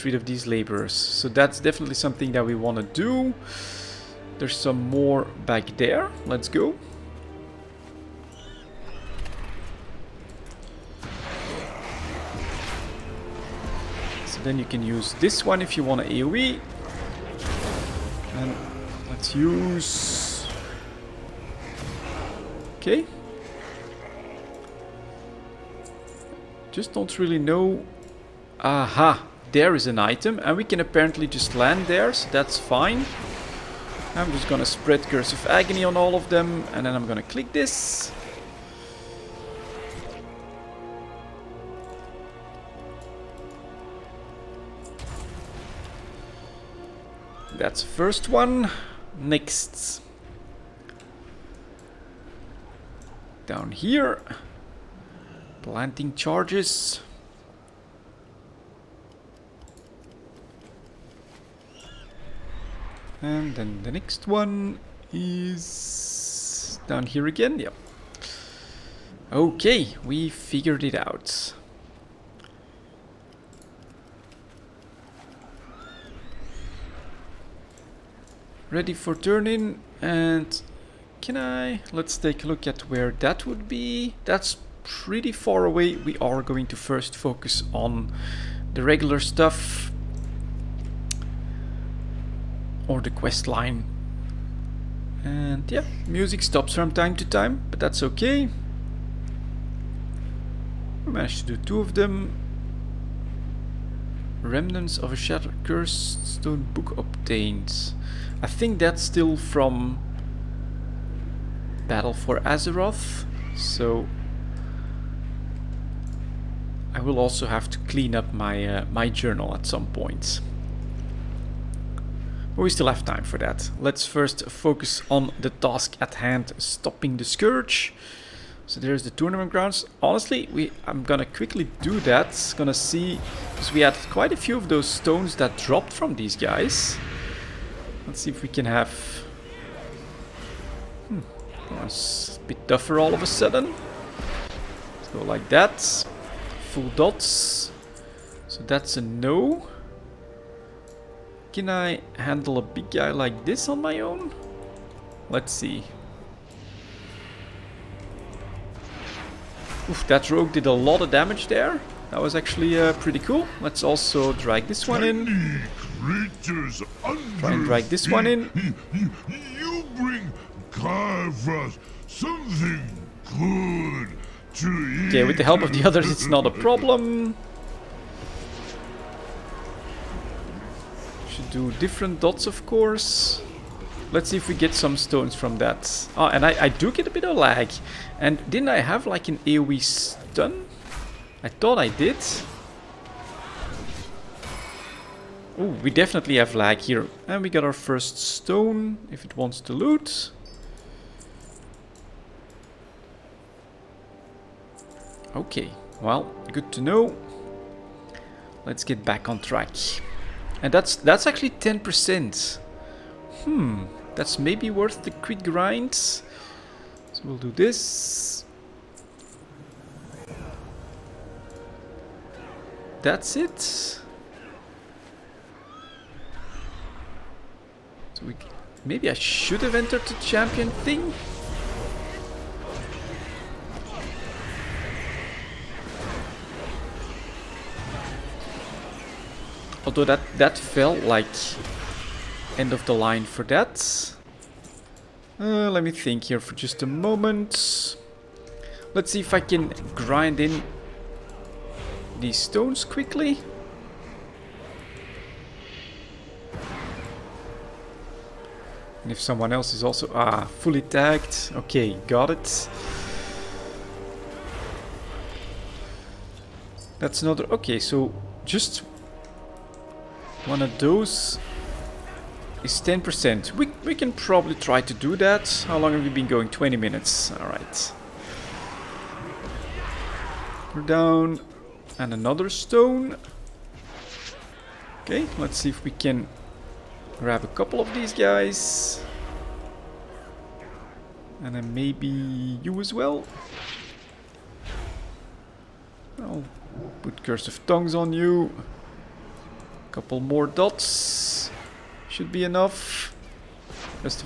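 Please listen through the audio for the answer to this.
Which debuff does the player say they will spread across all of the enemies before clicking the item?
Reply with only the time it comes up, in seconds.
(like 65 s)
35 s.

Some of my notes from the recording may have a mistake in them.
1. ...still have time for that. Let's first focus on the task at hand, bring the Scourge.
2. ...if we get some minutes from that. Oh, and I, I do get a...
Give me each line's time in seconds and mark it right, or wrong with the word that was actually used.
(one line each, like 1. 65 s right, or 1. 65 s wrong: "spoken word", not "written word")
1. 122 s wrong: "stopping", not "bring"
2. 184 s wrong: "stones", not "minutes".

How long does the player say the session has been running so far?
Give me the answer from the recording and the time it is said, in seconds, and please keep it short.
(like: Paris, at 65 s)
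20 minutes, at 276 s.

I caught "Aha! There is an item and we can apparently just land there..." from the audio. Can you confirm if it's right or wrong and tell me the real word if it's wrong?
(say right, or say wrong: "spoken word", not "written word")
right.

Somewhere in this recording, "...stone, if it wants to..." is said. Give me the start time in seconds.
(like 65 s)
198 s.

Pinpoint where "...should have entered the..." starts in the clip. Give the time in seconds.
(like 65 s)
229 s.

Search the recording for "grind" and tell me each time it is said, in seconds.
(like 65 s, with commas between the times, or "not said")
215 s, 249 s.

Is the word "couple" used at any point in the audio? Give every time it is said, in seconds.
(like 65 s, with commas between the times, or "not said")
287 s, 299 s.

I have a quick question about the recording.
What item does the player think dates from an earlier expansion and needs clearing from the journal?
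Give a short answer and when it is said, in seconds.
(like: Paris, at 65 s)
Remnants of a Shattered Cursed Stone Book, at 104 s.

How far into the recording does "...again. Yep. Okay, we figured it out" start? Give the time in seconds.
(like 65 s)
67 s.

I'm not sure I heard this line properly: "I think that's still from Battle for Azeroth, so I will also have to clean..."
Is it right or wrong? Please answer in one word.
right.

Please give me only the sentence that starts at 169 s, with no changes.
You bring Carvas something good to eat.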